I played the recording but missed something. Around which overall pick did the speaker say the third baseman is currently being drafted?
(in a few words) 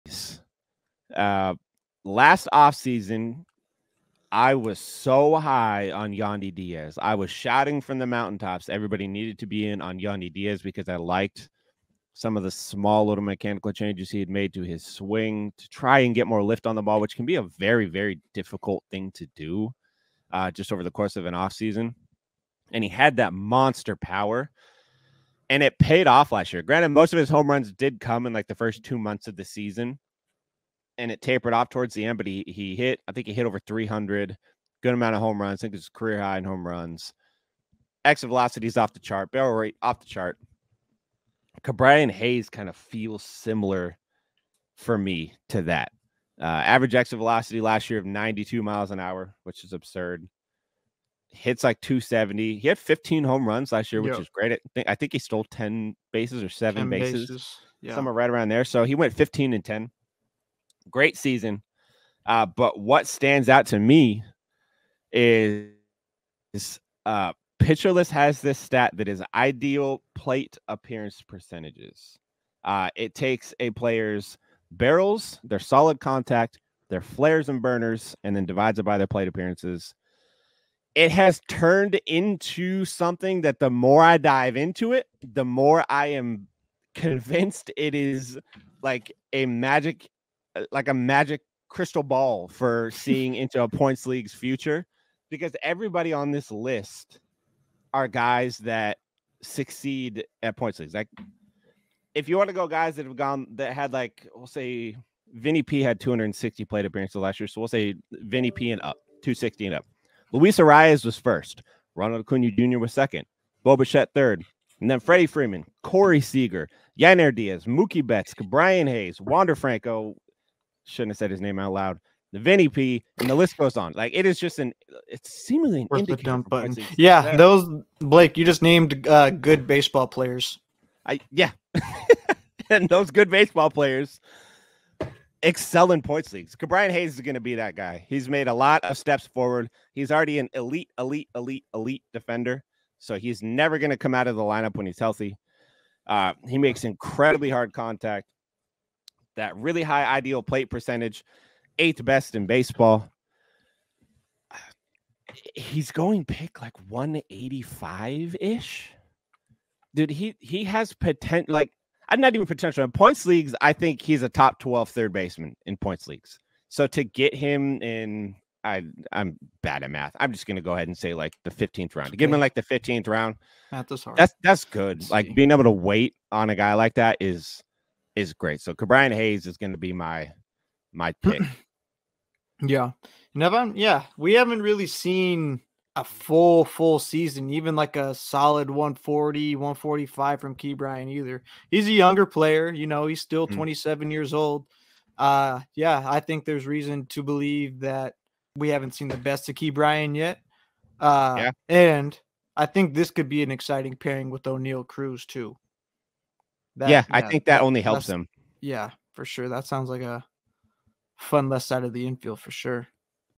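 185.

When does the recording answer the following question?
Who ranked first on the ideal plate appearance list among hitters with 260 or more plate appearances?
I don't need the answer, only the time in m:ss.
1:50.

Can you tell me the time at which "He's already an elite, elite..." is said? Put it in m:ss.
2:19.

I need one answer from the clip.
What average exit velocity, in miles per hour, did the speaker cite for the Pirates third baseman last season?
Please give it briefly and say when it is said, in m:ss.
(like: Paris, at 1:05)
92, at 0:48.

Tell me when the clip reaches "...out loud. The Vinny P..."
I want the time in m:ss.
2:01.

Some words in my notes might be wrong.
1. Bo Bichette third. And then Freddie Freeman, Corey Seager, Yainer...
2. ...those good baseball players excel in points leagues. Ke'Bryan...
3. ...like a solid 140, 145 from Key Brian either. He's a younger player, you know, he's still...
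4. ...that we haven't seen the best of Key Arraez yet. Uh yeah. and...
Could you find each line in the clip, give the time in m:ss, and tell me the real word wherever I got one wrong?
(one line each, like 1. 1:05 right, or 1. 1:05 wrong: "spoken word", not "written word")
1. 1:53 right
2. 2:12 right
3. 3:07 right
4. 3:17 wrong: "Brian", not "Arraez".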